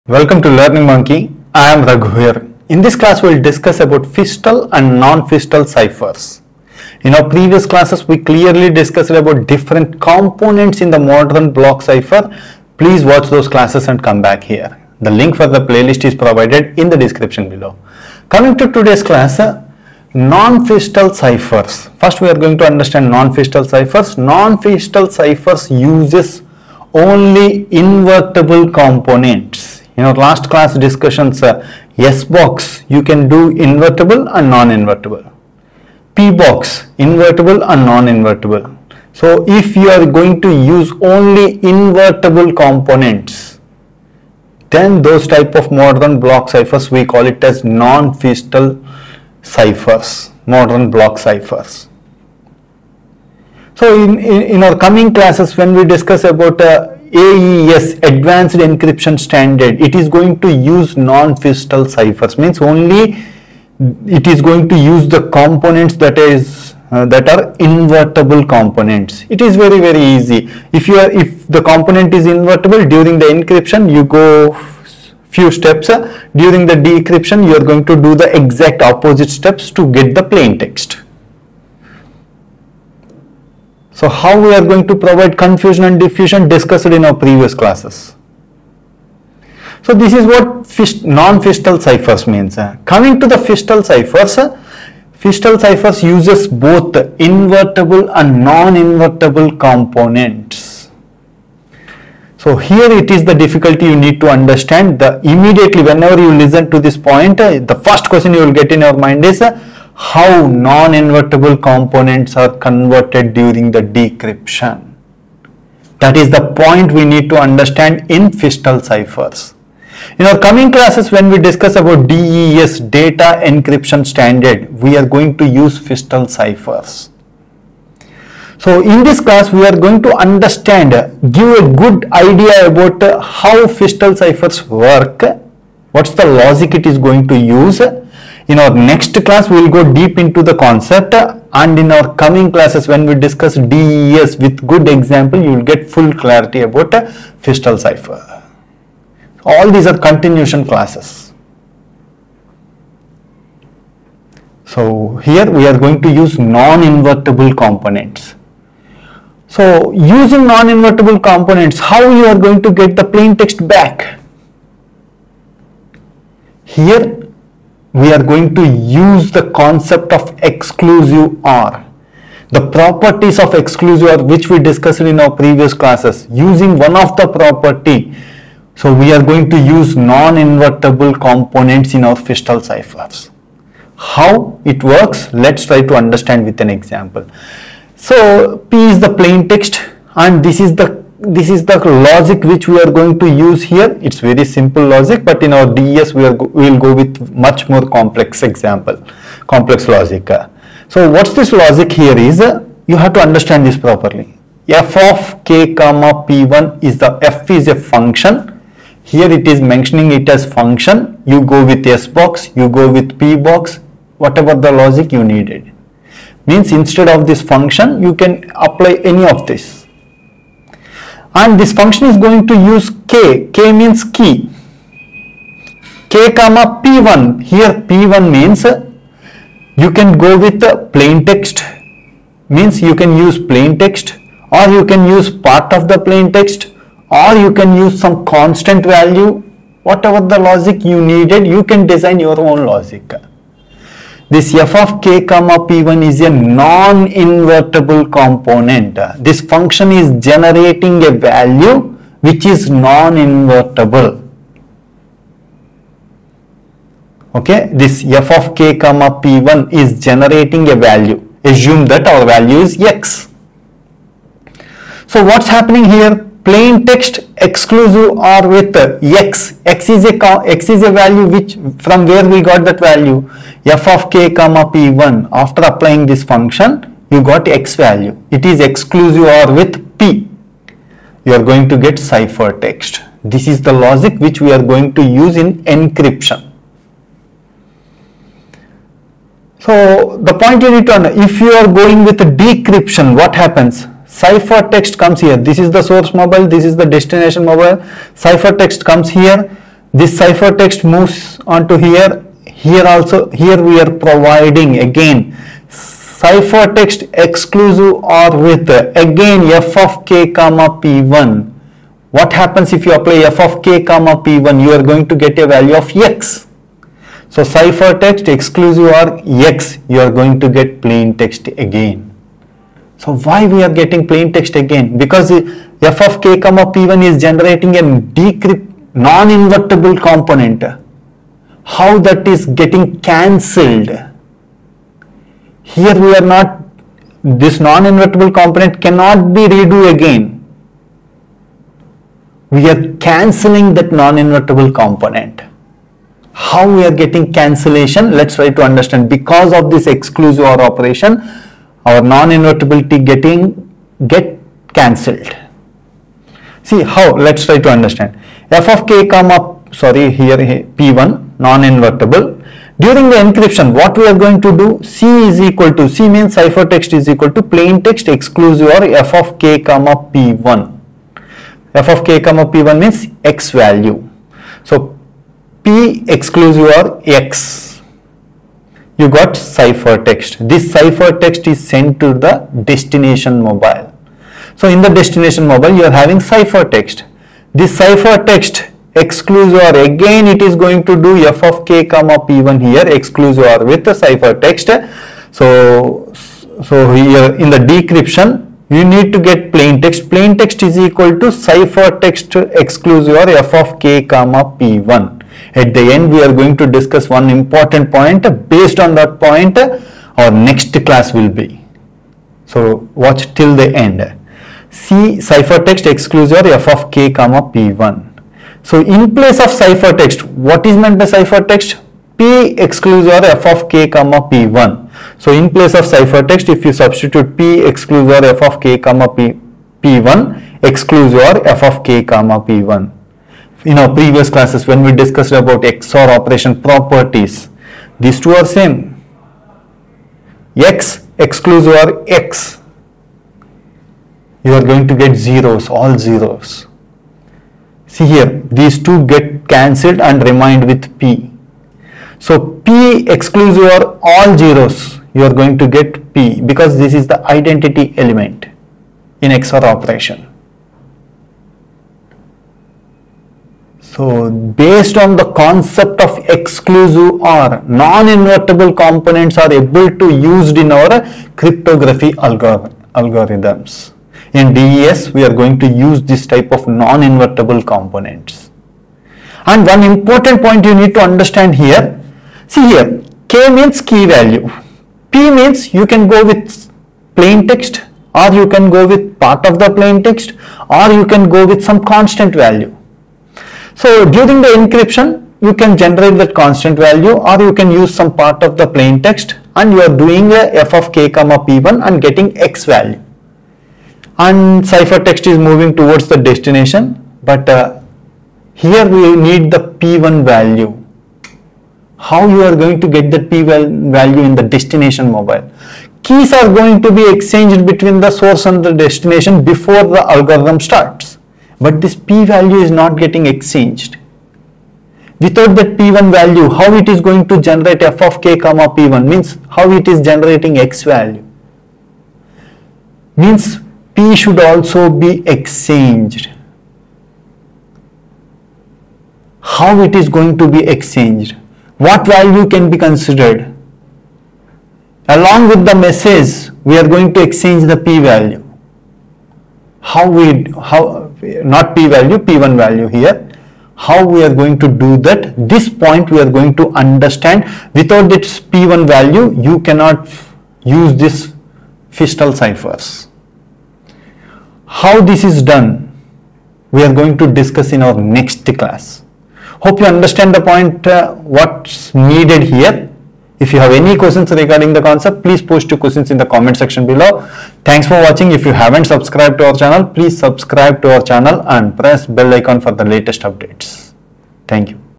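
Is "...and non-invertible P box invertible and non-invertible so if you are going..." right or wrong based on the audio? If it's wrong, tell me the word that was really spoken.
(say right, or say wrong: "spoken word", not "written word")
right.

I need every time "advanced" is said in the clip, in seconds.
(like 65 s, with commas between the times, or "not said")
58 s.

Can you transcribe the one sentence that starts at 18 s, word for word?
Coming to today's class, uh, non-Feistel ciphers.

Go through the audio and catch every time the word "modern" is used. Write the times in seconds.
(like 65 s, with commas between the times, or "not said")
10 s, 45 s, 50 s.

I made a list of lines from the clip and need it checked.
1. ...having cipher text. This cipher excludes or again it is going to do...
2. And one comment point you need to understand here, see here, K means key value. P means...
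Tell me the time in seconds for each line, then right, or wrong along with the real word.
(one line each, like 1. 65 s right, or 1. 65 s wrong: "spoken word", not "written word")
1. 385 s right
2. 479 s wrong: "important", not "comment".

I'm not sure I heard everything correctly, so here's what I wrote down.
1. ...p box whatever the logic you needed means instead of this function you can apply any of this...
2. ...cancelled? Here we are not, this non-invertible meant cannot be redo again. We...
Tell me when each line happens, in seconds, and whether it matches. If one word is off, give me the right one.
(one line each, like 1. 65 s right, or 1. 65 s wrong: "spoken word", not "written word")
1. 213 s right
2. 333 s wrong: "component", not "meant".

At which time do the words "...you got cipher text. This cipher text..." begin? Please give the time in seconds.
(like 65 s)
378 s.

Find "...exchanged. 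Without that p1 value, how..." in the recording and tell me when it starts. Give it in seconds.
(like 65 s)
523 s.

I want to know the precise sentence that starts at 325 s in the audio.
Because f of k comma p1 is generating a decrypt non-invertible component.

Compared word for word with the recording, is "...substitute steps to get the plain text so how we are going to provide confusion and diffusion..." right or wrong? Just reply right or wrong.
wrong.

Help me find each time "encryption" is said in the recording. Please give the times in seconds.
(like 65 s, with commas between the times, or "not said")
58 s, 73 s, 123 s, 285 s, 363 s, 494 s.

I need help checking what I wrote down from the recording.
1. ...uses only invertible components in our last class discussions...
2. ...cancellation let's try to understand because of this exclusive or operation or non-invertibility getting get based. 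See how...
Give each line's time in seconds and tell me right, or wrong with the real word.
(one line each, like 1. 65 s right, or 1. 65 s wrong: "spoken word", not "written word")
1. 25 s right
2. 347 s wrong: "cancelled", not "based".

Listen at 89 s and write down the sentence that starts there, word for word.
So this is what non-Feistel ciphers means.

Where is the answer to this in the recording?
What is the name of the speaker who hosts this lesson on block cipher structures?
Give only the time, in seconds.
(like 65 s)
1 s.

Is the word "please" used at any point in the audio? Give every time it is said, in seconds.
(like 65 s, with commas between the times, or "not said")
12 s, 575 s, 579 s.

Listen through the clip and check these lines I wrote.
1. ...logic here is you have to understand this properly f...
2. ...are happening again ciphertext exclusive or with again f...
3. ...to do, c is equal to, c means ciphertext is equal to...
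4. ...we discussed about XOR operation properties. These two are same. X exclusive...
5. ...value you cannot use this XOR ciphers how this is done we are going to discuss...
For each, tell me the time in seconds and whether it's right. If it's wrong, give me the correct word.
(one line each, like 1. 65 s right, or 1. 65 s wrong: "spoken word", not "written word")
1. 201 s right
2. 303 s wrong: "providing", not "happening"
3. 364 s right
4. 434 s right
5. 558 s wrong: "Feistel", not "XOR".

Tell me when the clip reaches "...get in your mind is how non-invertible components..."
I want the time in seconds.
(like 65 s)
108 s.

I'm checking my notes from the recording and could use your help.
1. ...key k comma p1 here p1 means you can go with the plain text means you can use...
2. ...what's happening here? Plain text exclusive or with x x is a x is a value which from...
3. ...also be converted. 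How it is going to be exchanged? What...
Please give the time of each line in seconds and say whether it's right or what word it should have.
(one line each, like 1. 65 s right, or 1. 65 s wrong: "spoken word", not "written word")
1. 224 s right
2. 265 s right
3. 534 s wrong: "exchanged", not "converted".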